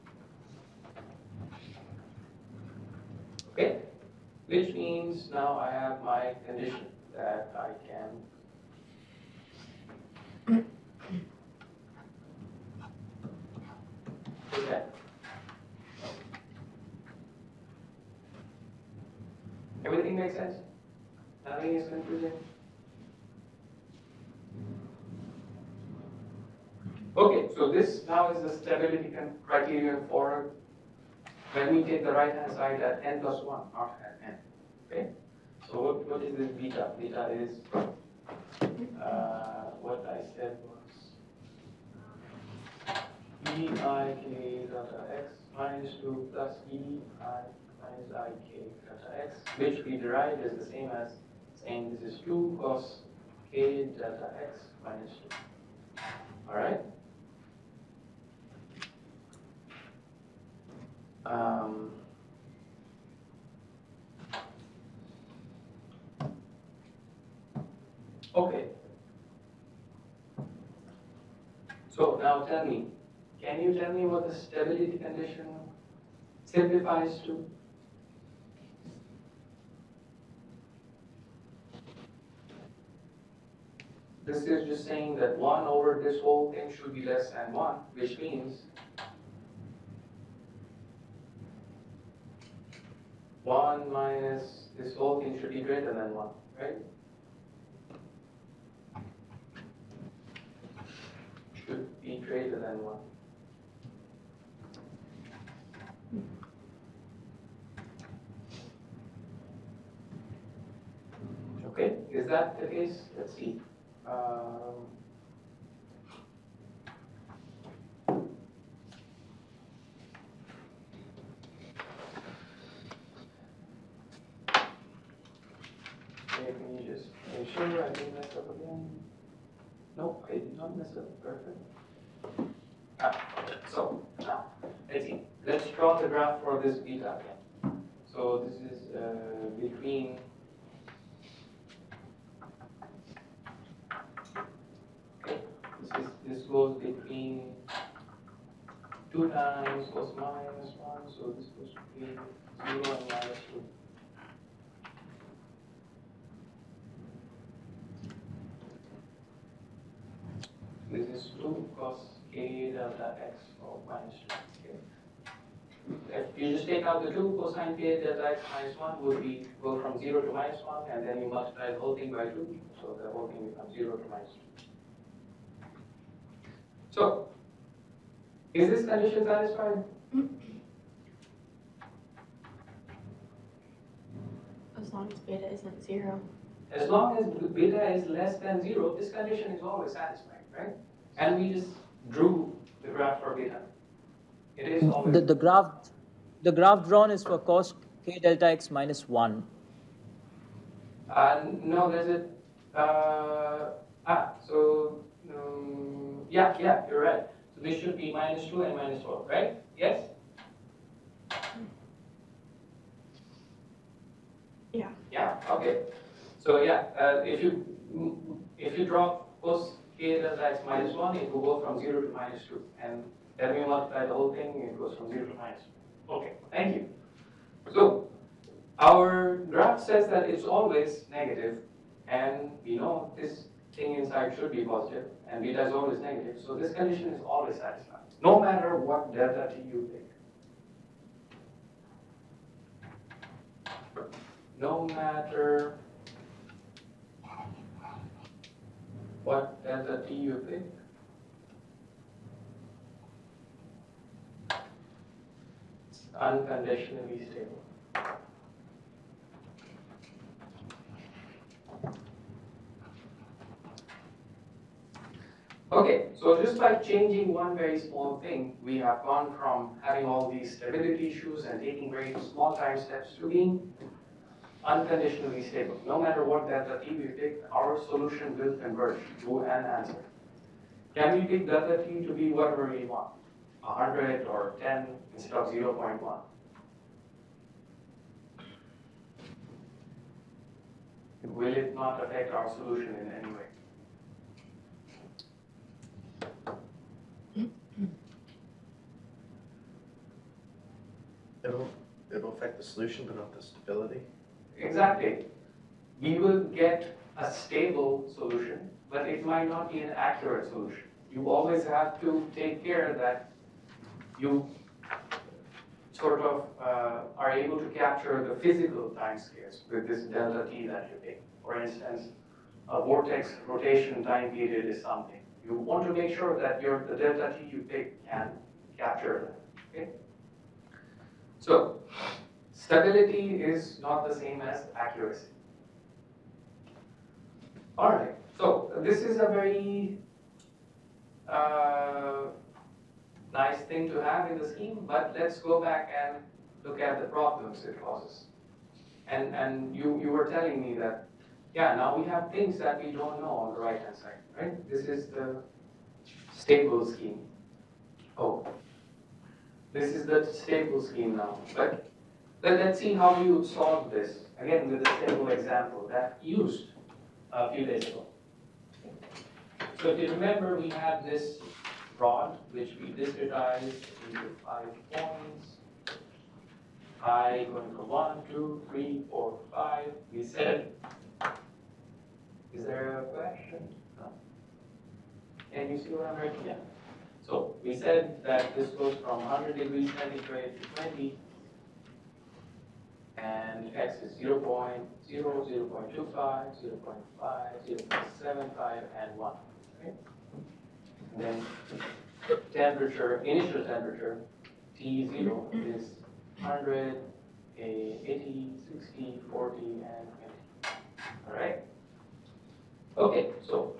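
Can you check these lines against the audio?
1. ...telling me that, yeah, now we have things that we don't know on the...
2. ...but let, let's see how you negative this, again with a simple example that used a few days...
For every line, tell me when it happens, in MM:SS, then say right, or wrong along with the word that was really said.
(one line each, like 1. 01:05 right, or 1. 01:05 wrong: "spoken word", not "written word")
1. 05:50 right
2. 06:01 wrong: "solve", not "negative".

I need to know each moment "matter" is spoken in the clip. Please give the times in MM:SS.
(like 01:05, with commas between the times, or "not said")
03:58, 04:04, 04:36.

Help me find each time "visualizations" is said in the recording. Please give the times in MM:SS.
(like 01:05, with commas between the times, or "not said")
not said.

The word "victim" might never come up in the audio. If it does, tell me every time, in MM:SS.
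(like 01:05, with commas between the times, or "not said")
not said.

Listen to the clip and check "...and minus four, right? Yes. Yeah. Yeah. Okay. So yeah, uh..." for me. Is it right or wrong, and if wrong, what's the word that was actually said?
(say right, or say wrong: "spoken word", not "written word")
right.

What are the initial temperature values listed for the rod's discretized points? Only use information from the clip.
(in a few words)
100, 80, 60, 40, 20.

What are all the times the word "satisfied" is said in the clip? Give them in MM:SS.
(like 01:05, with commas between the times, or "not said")
02:59, 03:09, 03:57.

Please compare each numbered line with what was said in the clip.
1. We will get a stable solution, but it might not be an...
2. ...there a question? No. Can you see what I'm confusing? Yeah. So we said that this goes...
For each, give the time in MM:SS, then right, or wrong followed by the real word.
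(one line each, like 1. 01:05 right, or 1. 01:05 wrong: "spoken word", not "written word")
1. 05:06 right
2. 06:22 wrong: "writing", not "confusing".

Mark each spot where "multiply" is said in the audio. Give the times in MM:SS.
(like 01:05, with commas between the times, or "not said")
02:51, 03:43.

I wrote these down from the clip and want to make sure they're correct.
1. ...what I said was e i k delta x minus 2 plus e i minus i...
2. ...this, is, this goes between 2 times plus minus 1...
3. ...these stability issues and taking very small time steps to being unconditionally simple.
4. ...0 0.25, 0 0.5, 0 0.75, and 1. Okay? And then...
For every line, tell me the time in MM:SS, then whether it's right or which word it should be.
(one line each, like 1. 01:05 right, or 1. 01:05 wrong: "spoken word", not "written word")
1. 00:39 right
2. 02:25 right
3. 04:30 wrong: "stable", not "simple"
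4. 06:35 right.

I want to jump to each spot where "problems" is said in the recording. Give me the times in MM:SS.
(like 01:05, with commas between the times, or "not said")
05:47.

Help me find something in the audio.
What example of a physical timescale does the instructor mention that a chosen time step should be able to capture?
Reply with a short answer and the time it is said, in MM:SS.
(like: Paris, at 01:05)
Vortex rotation time period, at 05:22.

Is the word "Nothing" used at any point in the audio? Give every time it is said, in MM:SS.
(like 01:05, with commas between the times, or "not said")
00:21.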